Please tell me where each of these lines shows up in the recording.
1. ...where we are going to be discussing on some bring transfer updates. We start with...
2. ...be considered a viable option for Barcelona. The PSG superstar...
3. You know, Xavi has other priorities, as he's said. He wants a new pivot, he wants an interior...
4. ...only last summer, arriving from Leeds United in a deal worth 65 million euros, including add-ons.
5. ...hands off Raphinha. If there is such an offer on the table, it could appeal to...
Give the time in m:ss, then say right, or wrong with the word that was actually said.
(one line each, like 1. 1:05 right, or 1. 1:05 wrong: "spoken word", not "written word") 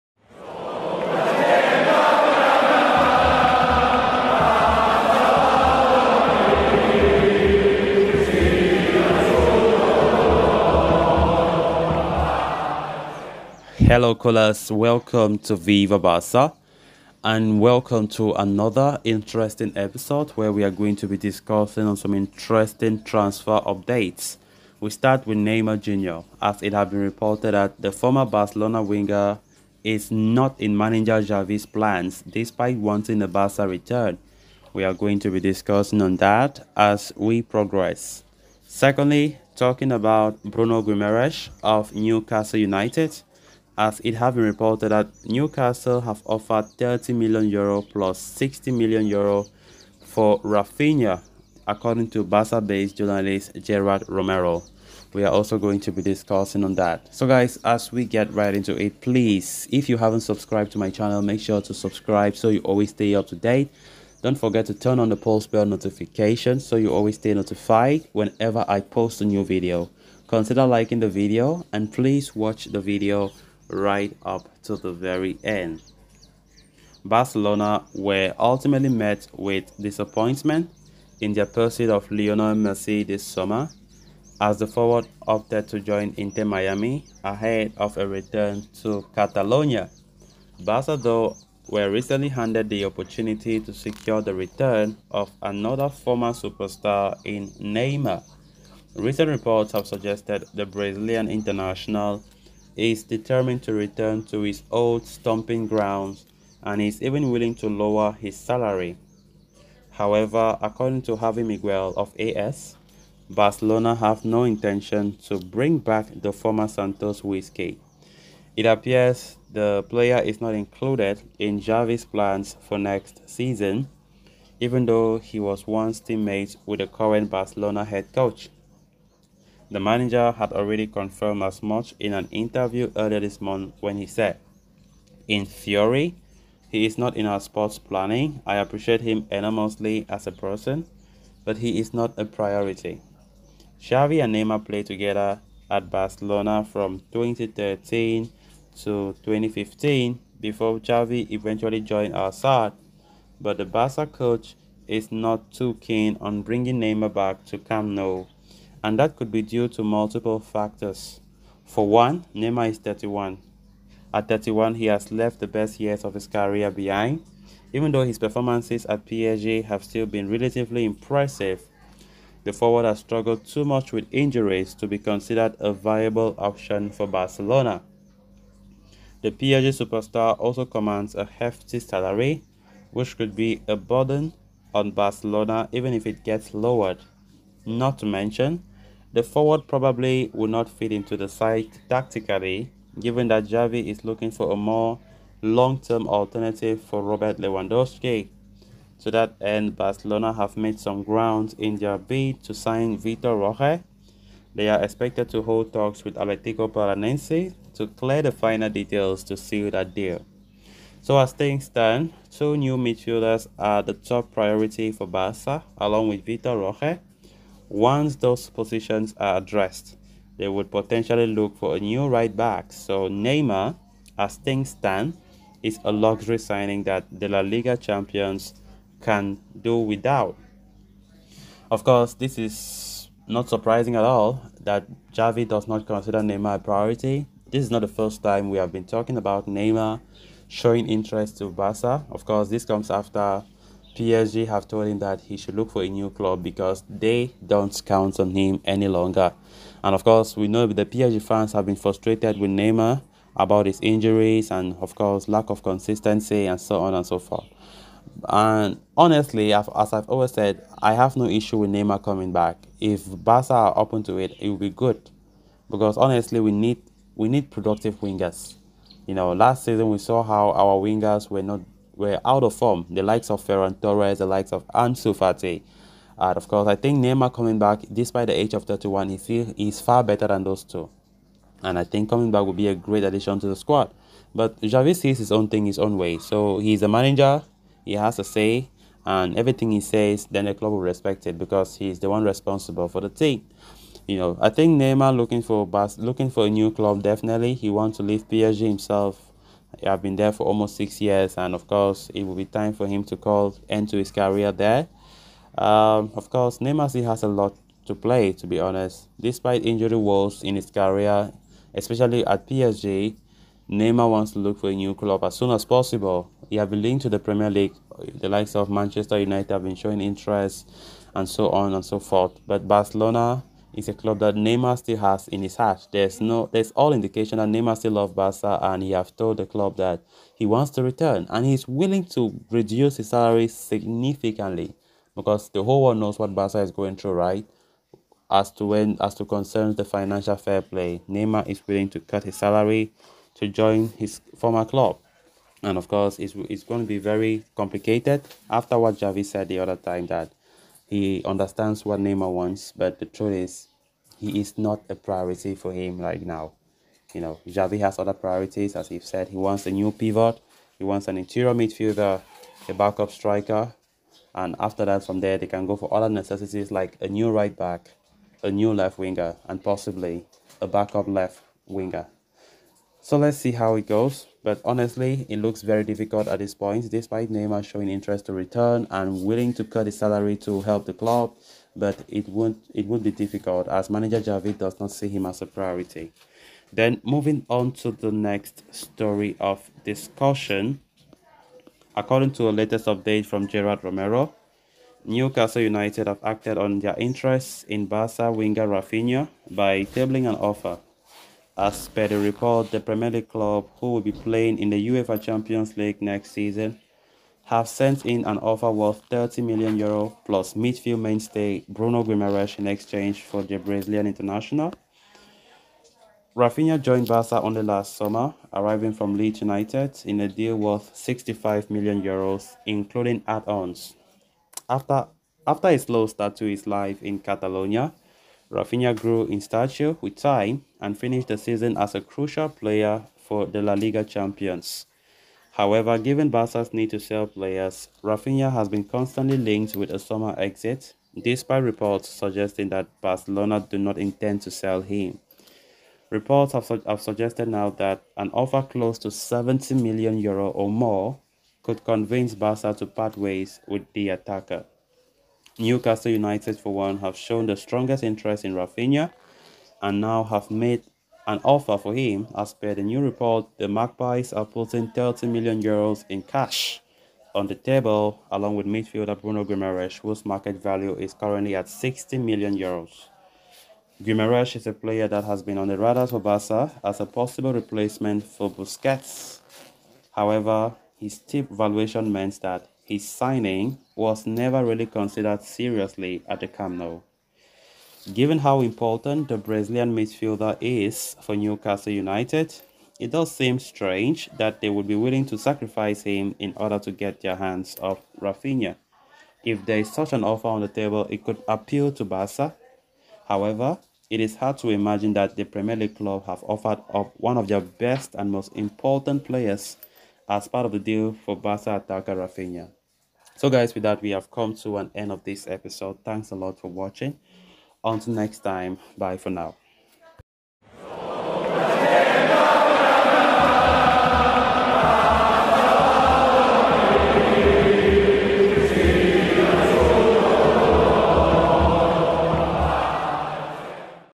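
1. 0:20 wrong: "interesting", not "bring"
2. 2:54 right
3. 5:57 right
4. 6:57 right
5. 8:17 right.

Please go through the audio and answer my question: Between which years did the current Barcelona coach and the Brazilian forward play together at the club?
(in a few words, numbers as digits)
2013 to 2015.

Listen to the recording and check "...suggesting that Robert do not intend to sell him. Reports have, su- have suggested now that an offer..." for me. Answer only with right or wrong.
wrong.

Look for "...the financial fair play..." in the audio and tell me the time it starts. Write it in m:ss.
5:39.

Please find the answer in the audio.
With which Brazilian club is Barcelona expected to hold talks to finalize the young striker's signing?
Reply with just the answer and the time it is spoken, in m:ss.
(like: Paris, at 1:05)
Athletico Paranaense, at 3:26.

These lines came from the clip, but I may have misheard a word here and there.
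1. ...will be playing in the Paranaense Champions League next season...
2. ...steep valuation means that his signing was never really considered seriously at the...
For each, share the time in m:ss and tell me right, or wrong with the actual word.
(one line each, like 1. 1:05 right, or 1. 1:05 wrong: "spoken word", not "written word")
1. 6:43 wrong: "UEFA", not "Paranaense"
2. 8:01 right.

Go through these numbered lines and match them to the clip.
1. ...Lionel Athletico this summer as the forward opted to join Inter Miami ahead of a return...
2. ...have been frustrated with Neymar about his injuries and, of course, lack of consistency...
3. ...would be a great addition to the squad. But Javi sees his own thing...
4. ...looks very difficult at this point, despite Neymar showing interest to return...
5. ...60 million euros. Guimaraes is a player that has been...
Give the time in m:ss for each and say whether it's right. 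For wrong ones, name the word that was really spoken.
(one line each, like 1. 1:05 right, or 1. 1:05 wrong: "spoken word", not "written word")
1. 1:22 wrong: "Messi", not "Athletico"
2. 4:11 right
3. 4:42 right
4. 6:15 right
5. 7:51 right.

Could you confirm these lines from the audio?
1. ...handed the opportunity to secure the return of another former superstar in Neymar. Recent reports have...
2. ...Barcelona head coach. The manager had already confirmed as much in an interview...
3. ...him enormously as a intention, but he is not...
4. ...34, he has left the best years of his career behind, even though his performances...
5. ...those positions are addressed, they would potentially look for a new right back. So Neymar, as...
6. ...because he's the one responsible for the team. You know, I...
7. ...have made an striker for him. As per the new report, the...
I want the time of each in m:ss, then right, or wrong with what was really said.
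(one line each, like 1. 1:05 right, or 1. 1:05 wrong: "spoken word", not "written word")
1. 1:32 right
2. 2:07 right
3. 2:18 wrong: "person", not "intention"
4. 2:44 wrong: "31", not "34"
5. 3:38 right
6. 4:51 right
7. 7:40 wrong: "offer", not "striker".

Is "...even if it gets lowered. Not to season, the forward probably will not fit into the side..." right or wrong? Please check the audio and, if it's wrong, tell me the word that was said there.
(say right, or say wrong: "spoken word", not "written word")
wrong: "mention", not "season".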